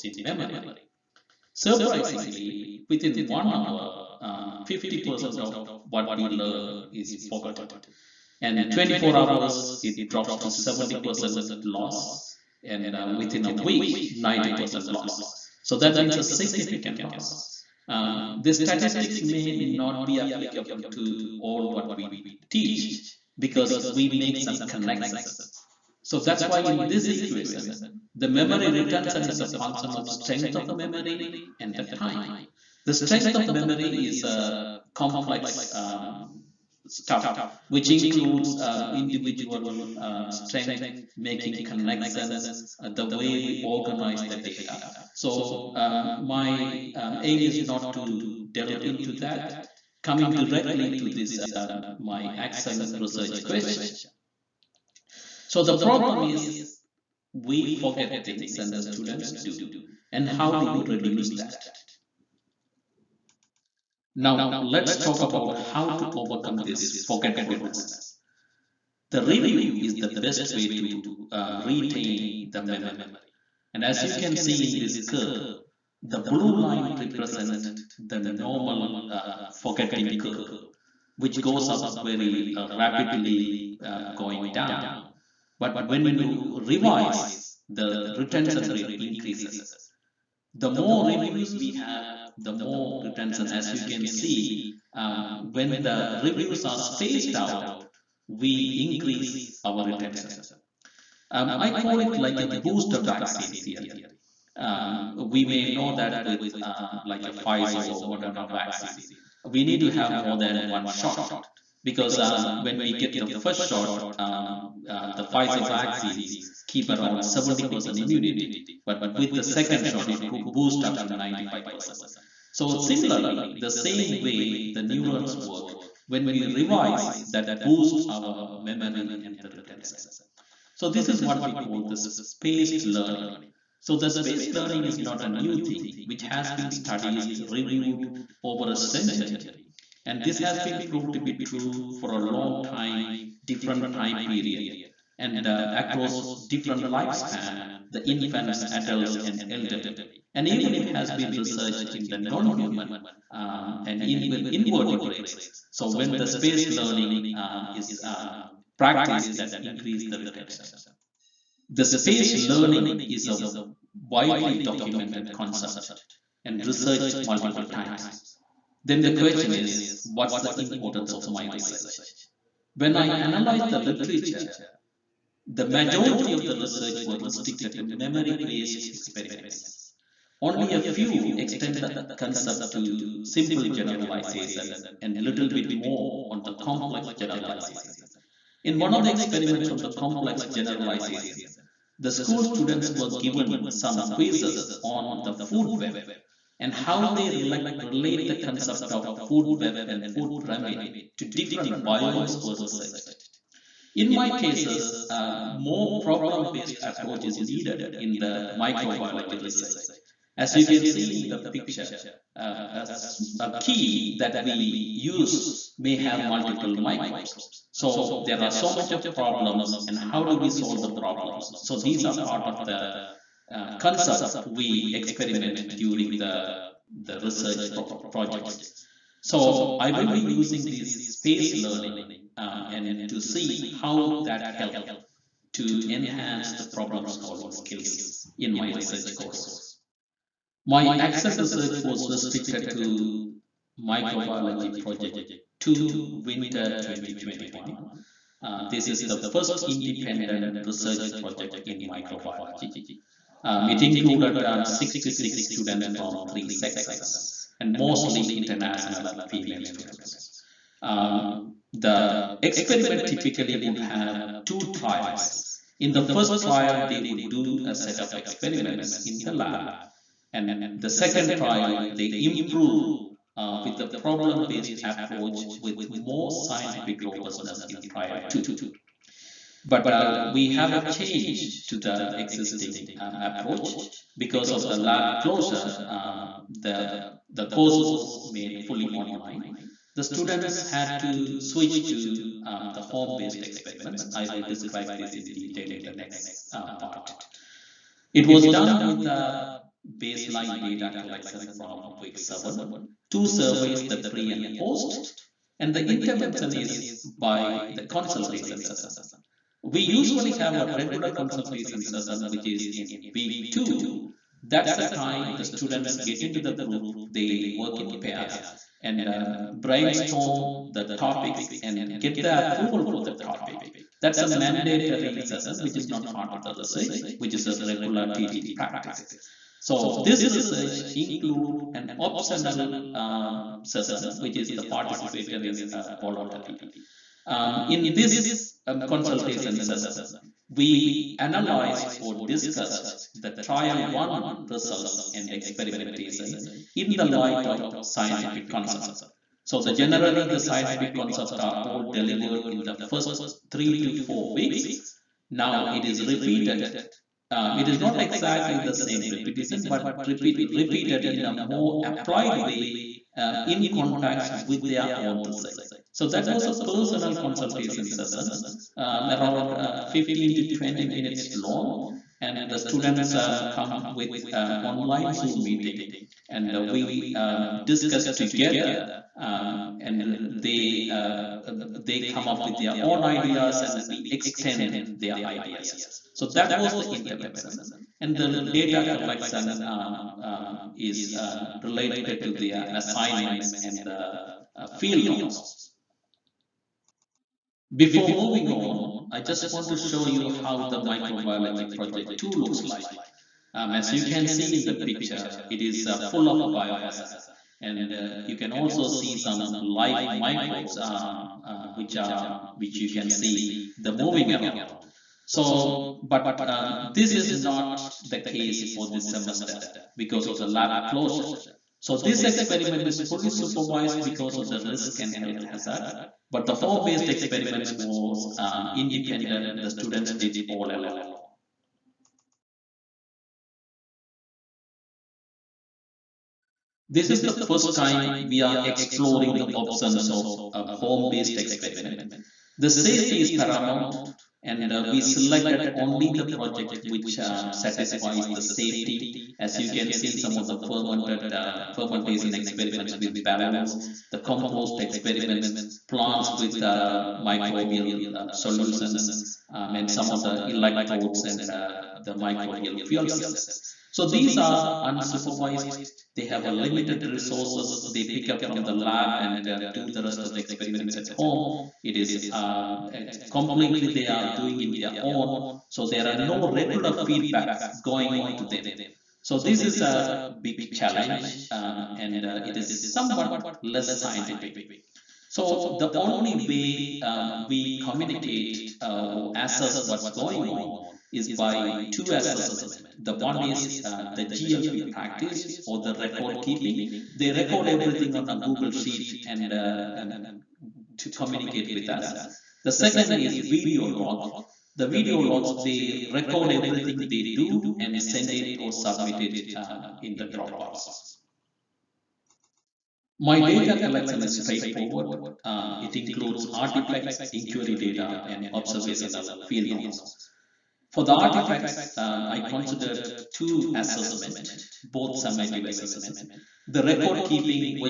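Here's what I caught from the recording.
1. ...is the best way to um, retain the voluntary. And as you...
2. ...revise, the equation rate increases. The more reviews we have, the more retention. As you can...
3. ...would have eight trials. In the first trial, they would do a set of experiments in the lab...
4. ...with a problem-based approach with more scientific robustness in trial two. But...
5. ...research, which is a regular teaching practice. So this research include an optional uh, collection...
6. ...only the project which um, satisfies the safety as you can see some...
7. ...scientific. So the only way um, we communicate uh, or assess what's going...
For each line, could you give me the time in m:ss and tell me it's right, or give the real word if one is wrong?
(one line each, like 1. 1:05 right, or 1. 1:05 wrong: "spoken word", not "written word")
1. 1:09 wrong: "memory", not "voluntary"
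2. 1:26 wrong: "retention", not "equation"
3. 4:23 wrong: "two", not "eight"
4. 4:33 right
5. 5:26 wrong: "session", not "collection"
6. 7:25 right
7. 8:04 right.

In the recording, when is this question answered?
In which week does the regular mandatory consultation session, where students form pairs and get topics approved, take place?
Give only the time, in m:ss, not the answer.
5:13.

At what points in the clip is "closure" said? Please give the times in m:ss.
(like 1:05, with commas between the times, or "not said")
4:45, 7:00.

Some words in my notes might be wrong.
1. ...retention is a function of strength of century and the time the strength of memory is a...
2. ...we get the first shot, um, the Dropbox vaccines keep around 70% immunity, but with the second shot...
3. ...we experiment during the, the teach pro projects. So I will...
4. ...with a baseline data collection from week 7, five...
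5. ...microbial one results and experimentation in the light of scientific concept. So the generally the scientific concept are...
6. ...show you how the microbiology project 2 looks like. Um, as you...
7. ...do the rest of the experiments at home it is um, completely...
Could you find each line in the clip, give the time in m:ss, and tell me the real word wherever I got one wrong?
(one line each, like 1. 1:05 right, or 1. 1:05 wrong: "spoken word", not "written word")
1. 0:28 wrong: "memory", not "century"
2. 1:52 wrong: "Pfizer", not "Dropbox"
3. 3:44 wrong: "research", not "teach"
4. 4:58 wrong: "two", not "five"
5. 5:43 wrong: "trial", not "microbial"
6. 6:39 right
7. 7:49 right.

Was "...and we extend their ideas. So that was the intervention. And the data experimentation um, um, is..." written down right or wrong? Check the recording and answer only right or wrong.
wrong.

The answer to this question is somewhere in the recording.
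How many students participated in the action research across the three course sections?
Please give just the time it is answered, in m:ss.
4:14.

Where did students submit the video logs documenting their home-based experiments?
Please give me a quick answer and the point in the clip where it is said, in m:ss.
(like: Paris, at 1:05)
Dropbox, at 8:30.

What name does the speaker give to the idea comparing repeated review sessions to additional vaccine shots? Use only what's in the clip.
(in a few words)
booster vaccine theory.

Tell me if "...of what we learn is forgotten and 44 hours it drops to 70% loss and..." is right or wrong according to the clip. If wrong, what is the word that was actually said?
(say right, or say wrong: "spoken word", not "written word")
wrong: "24", not "44".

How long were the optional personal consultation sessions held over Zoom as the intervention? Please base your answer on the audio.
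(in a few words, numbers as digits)
15 to 20 minutes.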